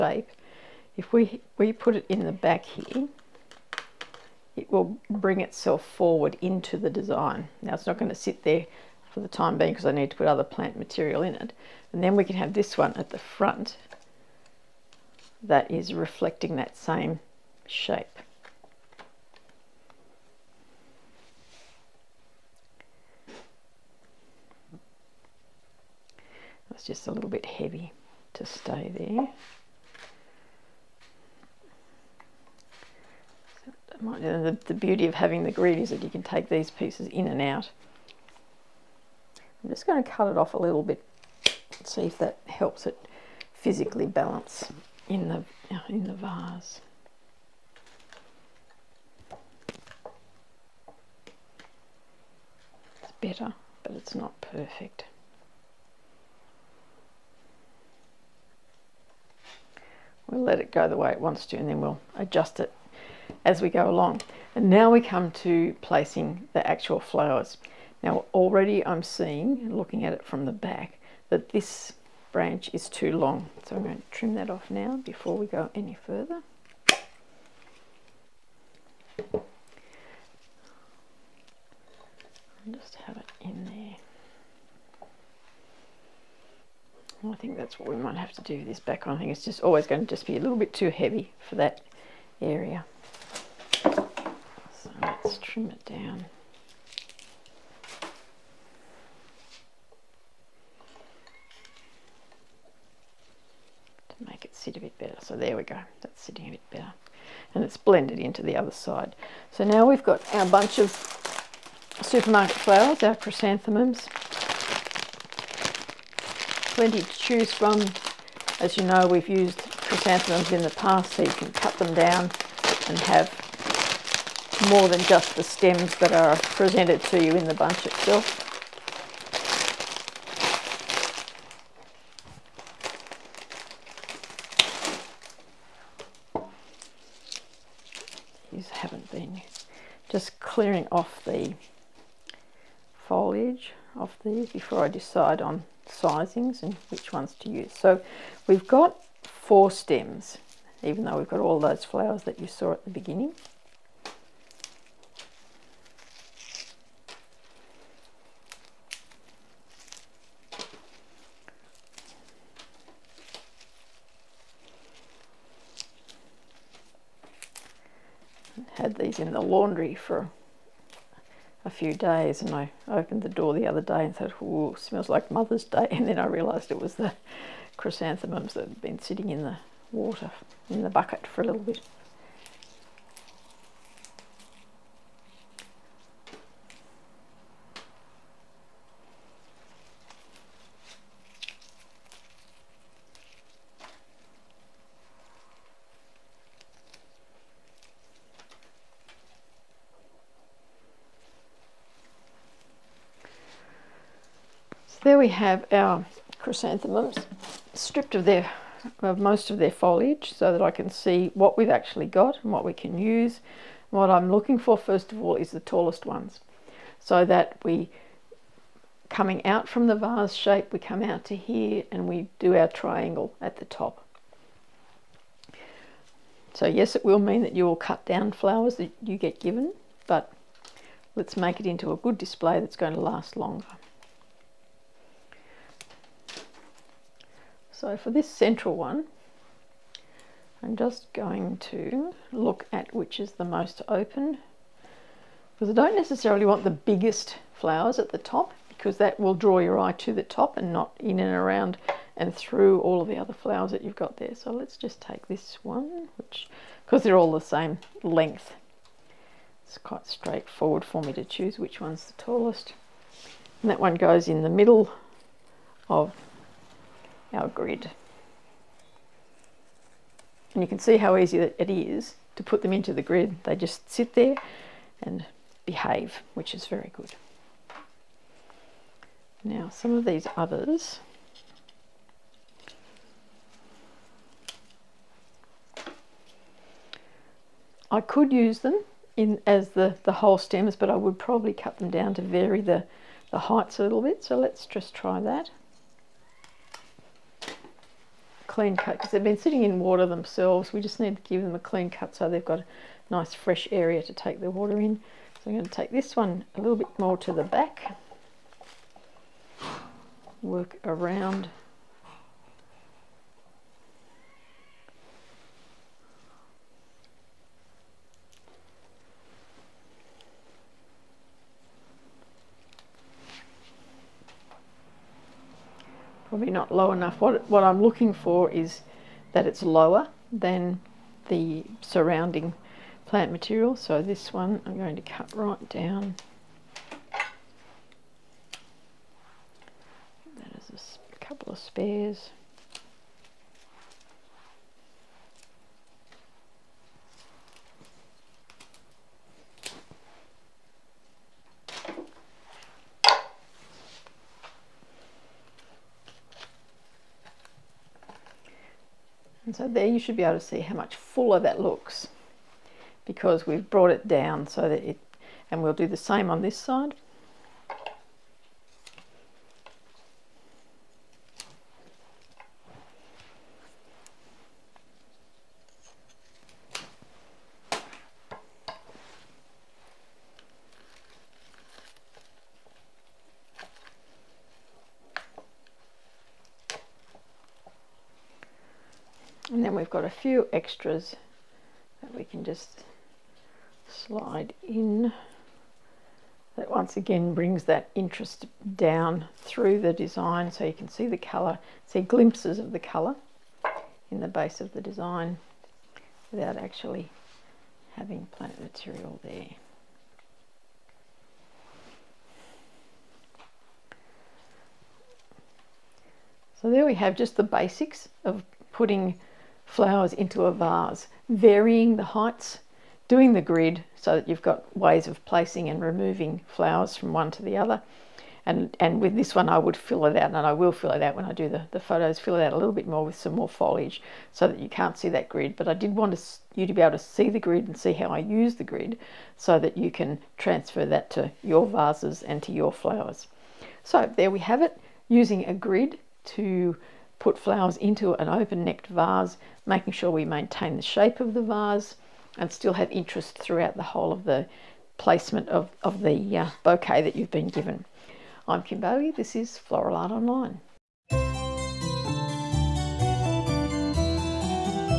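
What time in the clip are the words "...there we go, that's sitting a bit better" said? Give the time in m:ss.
1:45.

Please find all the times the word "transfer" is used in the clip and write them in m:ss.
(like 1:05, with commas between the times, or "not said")
7:20.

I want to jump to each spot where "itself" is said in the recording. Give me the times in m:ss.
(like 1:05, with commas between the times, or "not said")
0:05, 2:07.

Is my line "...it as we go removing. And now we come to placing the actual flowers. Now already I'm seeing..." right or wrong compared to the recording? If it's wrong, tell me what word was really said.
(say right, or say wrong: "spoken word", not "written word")
wrong: "along", not "removing".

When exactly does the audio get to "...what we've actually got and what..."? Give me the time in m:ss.
3:31.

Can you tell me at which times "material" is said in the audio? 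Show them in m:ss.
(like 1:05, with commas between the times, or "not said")
0:10, 5:33, 6:48.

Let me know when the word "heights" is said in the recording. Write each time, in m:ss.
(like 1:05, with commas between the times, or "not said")
4:53, 7:02.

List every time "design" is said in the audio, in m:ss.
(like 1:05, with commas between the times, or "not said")
0:06, 6:39, 6:44.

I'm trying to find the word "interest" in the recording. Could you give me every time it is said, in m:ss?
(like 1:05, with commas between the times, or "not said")
6:37, 7:32.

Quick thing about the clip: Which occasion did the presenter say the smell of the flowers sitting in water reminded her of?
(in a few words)
Mother's Day.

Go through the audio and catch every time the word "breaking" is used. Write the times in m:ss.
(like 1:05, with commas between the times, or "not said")
not said.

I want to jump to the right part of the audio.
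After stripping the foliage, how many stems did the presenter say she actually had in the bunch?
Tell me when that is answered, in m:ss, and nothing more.
2:29.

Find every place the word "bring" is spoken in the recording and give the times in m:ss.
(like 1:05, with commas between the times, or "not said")
0:05, 6:37.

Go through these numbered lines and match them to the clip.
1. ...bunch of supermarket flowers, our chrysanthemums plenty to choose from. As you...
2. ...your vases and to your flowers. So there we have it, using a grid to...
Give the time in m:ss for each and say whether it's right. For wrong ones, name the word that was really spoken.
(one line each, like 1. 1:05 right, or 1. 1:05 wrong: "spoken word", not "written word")
1. 1:50 right
2. 7:21 right.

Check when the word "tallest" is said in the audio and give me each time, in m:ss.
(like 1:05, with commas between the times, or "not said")
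3:35, 4:22.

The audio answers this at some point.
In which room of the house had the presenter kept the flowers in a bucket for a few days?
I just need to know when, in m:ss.
2:49.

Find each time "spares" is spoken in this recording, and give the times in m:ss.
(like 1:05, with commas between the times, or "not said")
5:41.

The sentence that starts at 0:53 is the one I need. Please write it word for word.
It's better, but it's not perfect.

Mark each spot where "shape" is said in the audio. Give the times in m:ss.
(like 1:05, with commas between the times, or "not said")
0:17, 3:40, 7:30.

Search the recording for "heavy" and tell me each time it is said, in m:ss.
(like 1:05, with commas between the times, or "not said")
0:27, 1:30.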